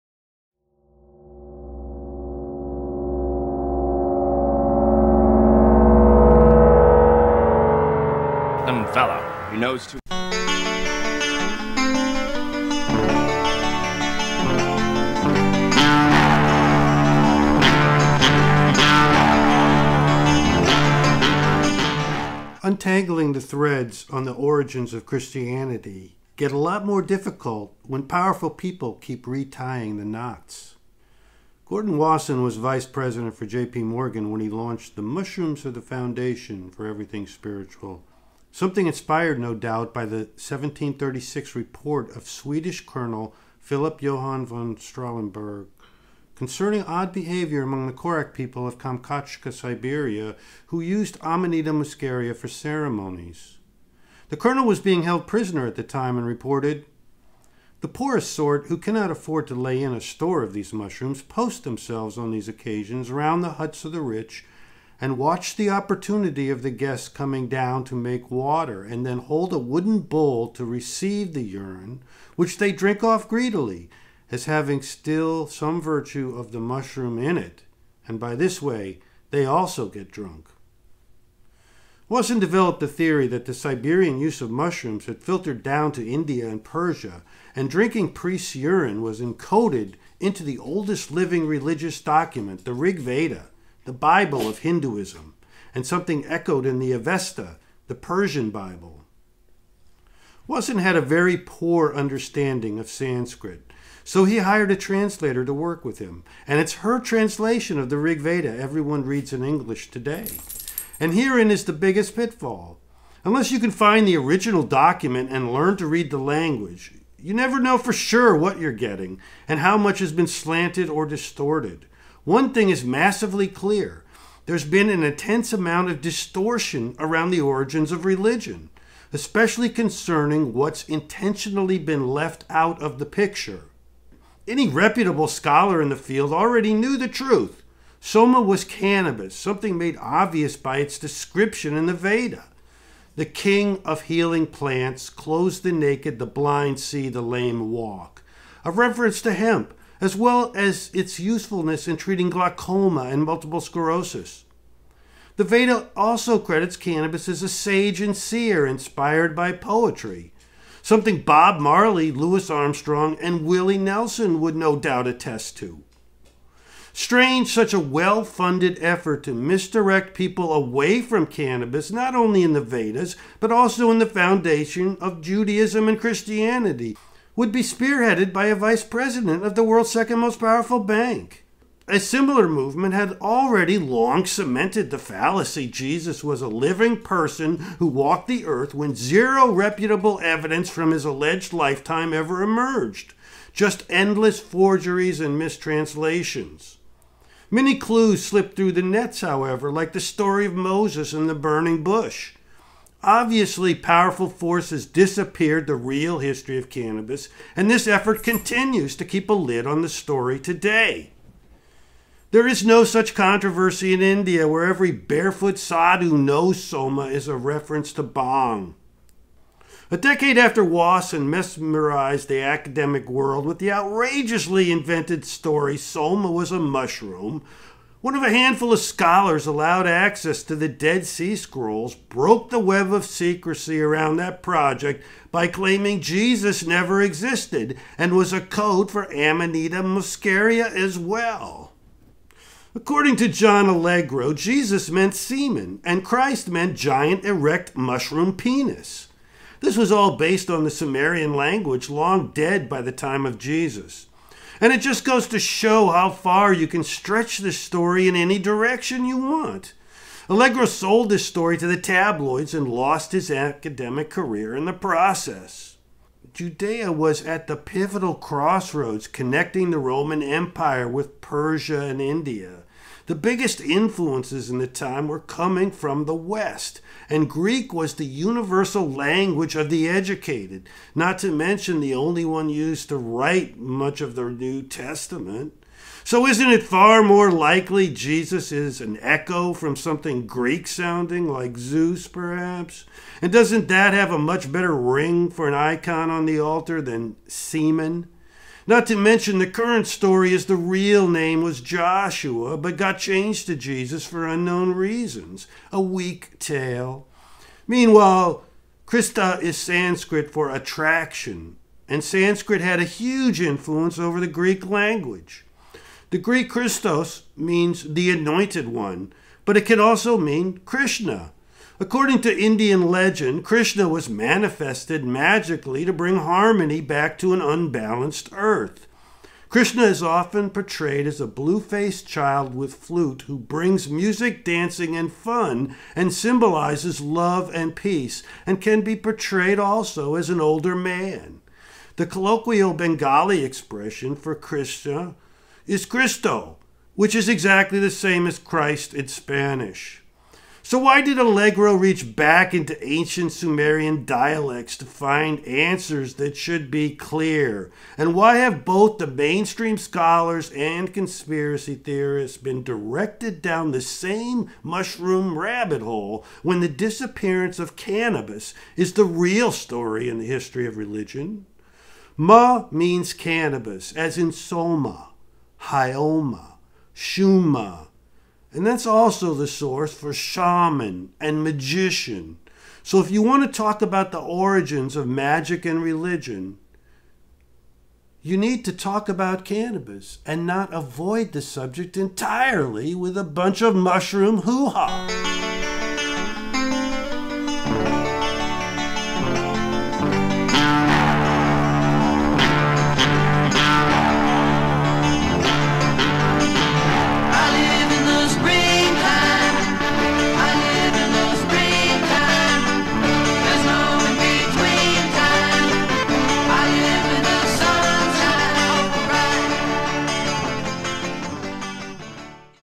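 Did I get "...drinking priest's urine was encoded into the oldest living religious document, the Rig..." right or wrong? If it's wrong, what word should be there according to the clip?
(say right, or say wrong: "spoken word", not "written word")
right.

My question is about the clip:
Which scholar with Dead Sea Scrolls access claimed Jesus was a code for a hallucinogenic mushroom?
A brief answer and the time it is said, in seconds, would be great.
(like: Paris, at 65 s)
John Allegro, at 243 s.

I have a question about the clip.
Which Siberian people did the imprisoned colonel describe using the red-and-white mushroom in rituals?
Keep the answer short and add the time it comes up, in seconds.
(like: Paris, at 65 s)
Korak, at 47 s.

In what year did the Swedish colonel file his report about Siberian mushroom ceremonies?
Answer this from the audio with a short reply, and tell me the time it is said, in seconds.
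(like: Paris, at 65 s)
1736, at 40 s.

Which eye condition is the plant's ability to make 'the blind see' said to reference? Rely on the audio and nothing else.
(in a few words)
glaucoma.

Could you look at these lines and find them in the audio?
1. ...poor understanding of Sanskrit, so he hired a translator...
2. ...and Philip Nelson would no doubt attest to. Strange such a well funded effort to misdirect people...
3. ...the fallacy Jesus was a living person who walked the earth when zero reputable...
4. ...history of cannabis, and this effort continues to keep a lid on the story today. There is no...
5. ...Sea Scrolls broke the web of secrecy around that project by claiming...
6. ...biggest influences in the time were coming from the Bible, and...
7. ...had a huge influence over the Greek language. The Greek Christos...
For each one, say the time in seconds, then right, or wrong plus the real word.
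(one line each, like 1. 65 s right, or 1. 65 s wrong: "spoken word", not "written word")
1. 101 s right
2. 163 s wrong: "Willie", not "Philip"
3. 184 s right
4. 206 s right
5. 231 s right
6. 273 s wrong: "West", not "Bible"
7. 312 s right.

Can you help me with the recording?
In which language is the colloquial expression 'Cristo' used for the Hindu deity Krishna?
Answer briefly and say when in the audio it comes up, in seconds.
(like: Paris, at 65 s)
Bengali, at 342 s.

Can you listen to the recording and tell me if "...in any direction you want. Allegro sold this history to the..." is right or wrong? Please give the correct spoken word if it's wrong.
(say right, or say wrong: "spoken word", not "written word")
wrong: "story", not "history".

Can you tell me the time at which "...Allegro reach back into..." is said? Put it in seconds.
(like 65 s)
351 s.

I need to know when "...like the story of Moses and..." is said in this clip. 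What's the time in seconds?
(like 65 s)
199 s.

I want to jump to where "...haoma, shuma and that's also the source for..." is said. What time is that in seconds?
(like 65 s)
375 s.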